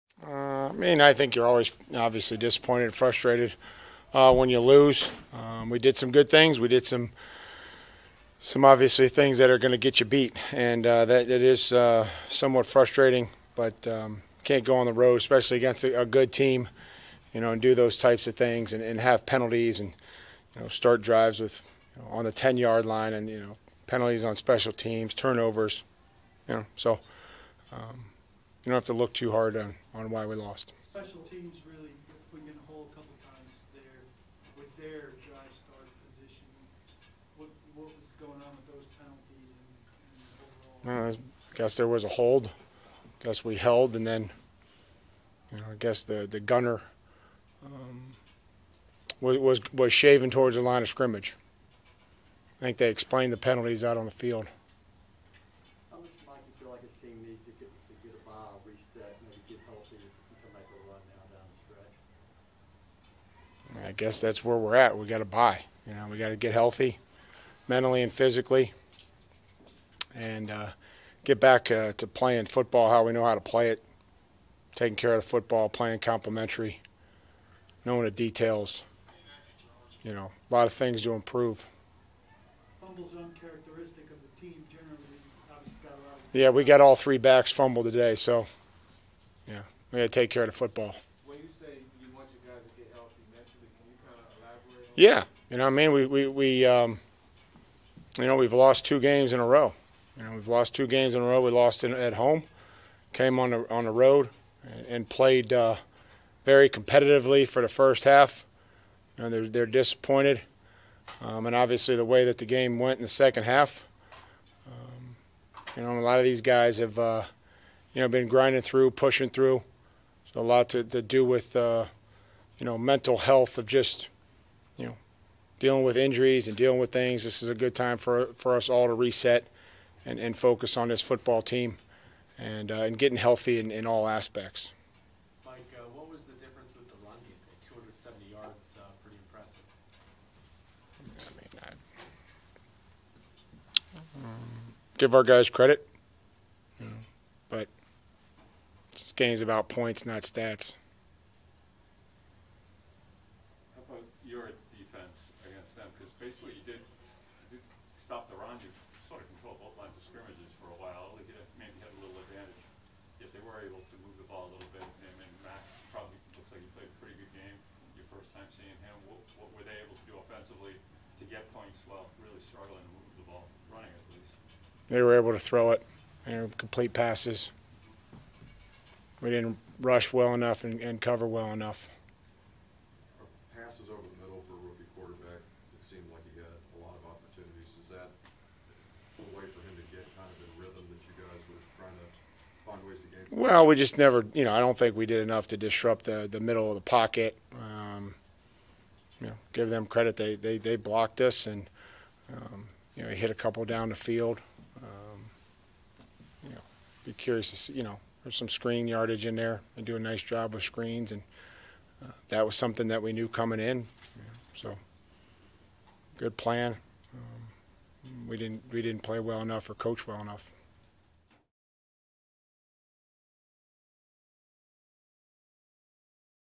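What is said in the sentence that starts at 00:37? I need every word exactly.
What, what was going on with those penalties and, and overall?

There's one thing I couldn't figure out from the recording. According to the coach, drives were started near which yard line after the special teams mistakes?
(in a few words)
10 yard line.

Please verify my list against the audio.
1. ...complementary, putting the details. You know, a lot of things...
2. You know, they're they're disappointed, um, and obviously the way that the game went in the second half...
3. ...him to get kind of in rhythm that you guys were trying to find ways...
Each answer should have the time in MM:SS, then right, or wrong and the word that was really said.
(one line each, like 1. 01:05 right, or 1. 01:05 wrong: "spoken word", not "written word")
1. 01:15 wrong: "knowing", not "putting"
2. 01:49 right
3. 03:09 right.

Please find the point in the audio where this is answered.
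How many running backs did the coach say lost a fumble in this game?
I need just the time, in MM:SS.
01:26.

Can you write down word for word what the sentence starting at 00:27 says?
Um, you don't have to look too hard on, on why we lost.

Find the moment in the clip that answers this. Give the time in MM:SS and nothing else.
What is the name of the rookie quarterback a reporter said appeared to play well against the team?
02:45.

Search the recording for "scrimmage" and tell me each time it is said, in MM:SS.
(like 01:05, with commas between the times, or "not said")
00:50, 02:40.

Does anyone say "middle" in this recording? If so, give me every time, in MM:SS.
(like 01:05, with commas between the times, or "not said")
03:04, 03:16.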